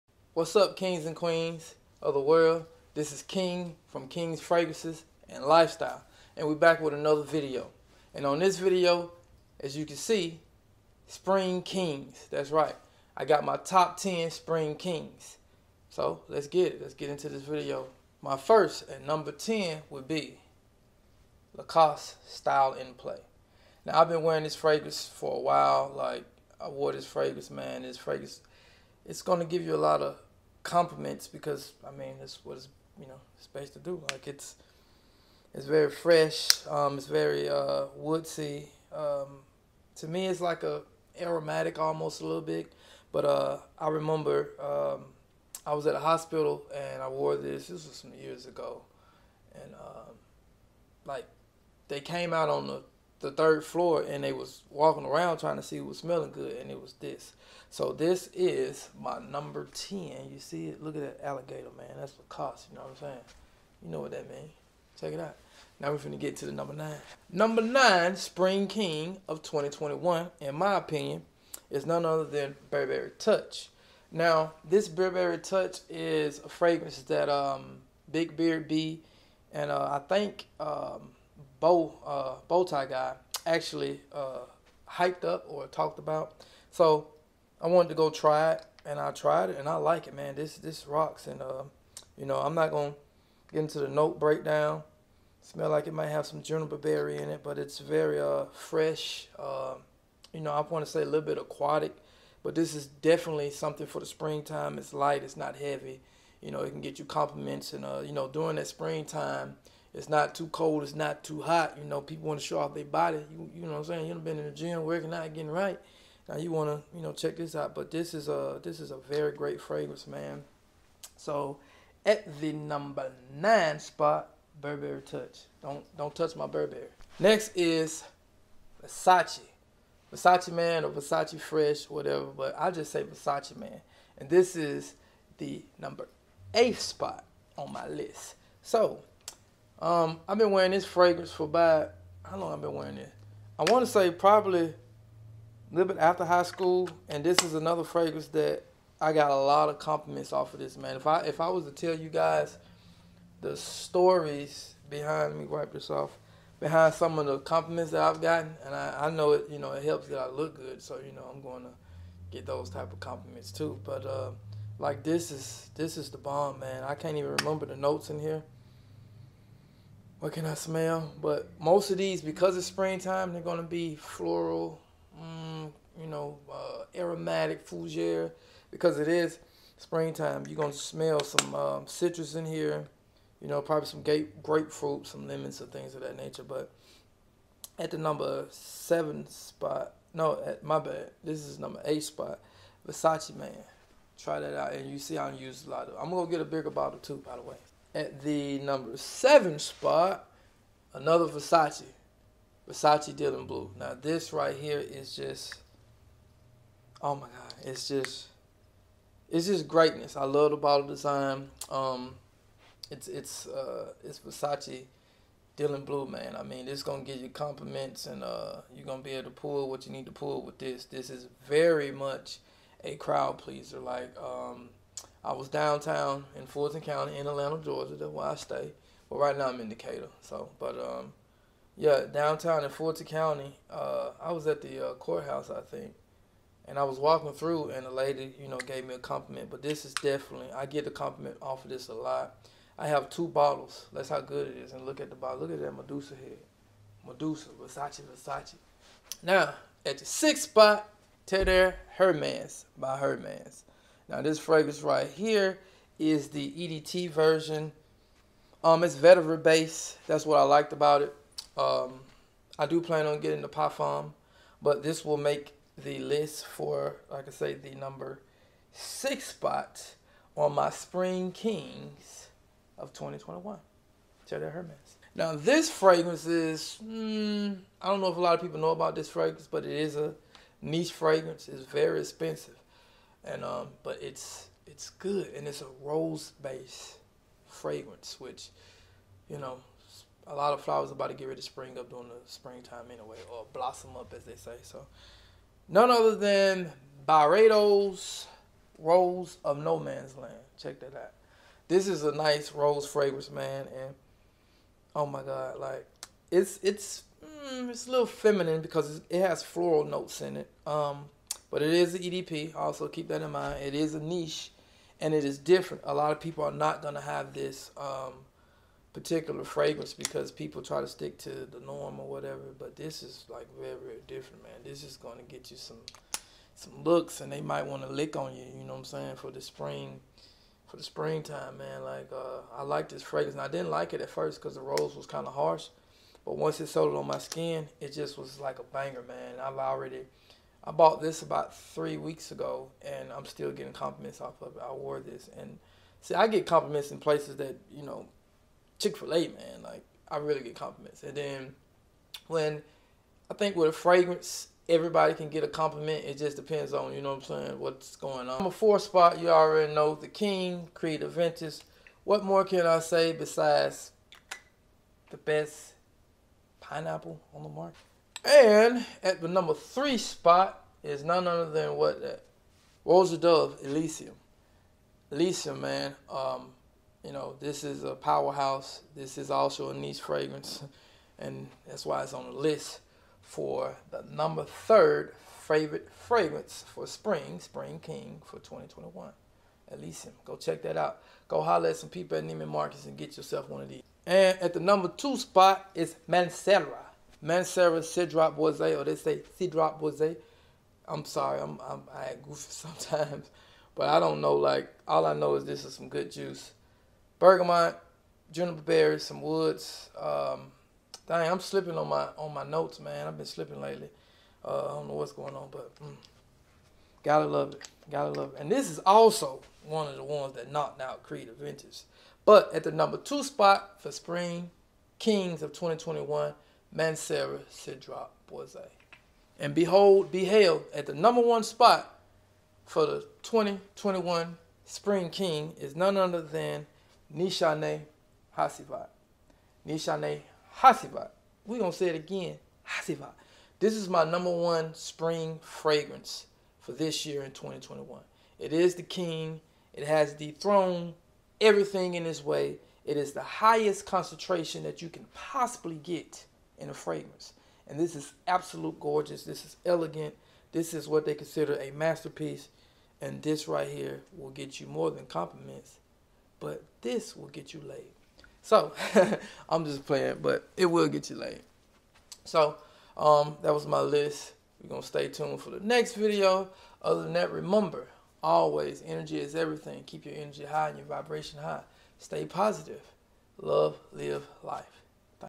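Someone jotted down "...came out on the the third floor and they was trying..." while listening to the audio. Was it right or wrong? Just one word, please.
wrong.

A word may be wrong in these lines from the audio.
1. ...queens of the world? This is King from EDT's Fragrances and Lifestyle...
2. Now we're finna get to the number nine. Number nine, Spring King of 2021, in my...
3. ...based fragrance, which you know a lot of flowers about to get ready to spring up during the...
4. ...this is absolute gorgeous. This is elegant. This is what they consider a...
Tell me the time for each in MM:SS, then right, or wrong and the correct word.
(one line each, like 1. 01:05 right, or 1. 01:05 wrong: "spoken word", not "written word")
1. 00:01 wrong: "King", not "EDT"
2. 01:05 right
3. 04:46 right
4. 07:37 right.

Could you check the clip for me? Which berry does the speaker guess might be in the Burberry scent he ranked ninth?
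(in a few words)
juniper berry.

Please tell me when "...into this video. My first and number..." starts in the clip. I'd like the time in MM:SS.
00:17.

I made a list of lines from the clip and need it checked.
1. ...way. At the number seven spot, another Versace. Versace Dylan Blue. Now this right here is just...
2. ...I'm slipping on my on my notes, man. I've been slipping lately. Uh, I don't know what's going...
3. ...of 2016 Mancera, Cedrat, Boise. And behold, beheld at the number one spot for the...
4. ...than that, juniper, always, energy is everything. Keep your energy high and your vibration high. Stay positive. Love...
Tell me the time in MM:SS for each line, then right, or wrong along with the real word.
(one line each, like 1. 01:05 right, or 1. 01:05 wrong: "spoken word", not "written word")
1. 03:17 right
2. 06:51 right
3. 07:05 wrong: "2021", not "2016"
4. 07:57 wrong: "remember", not "juniper".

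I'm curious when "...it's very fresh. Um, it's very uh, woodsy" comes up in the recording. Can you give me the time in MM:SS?
00:35.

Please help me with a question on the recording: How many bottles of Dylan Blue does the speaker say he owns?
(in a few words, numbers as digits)
2.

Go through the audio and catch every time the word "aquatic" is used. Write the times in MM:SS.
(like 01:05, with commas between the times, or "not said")
01:41.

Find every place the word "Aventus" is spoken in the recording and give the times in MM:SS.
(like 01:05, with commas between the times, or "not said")
06:01, 07:01.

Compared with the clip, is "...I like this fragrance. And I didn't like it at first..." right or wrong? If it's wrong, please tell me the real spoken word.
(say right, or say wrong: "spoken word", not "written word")
right.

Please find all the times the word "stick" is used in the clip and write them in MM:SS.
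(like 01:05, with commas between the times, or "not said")
05:20.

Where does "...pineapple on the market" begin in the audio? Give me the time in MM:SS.
06:06.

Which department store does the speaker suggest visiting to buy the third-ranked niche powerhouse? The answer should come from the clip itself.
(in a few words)
Neiman Marcus.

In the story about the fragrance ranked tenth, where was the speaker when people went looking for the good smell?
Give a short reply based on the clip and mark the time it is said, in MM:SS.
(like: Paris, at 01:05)
a hospital, at 00:45.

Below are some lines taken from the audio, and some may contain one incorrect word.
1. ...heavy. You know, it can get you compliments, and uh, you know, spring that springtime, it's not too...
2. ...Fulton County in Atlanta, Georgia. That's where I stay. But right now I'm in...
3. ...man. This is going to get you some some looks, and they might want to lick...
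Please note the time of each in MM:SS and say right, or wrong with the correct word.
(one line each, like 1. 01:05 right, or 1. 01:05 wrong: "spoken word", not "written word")
1. 01:45 wrong: "during", not "spring"
2. 03:46 right
3. 05:24 right.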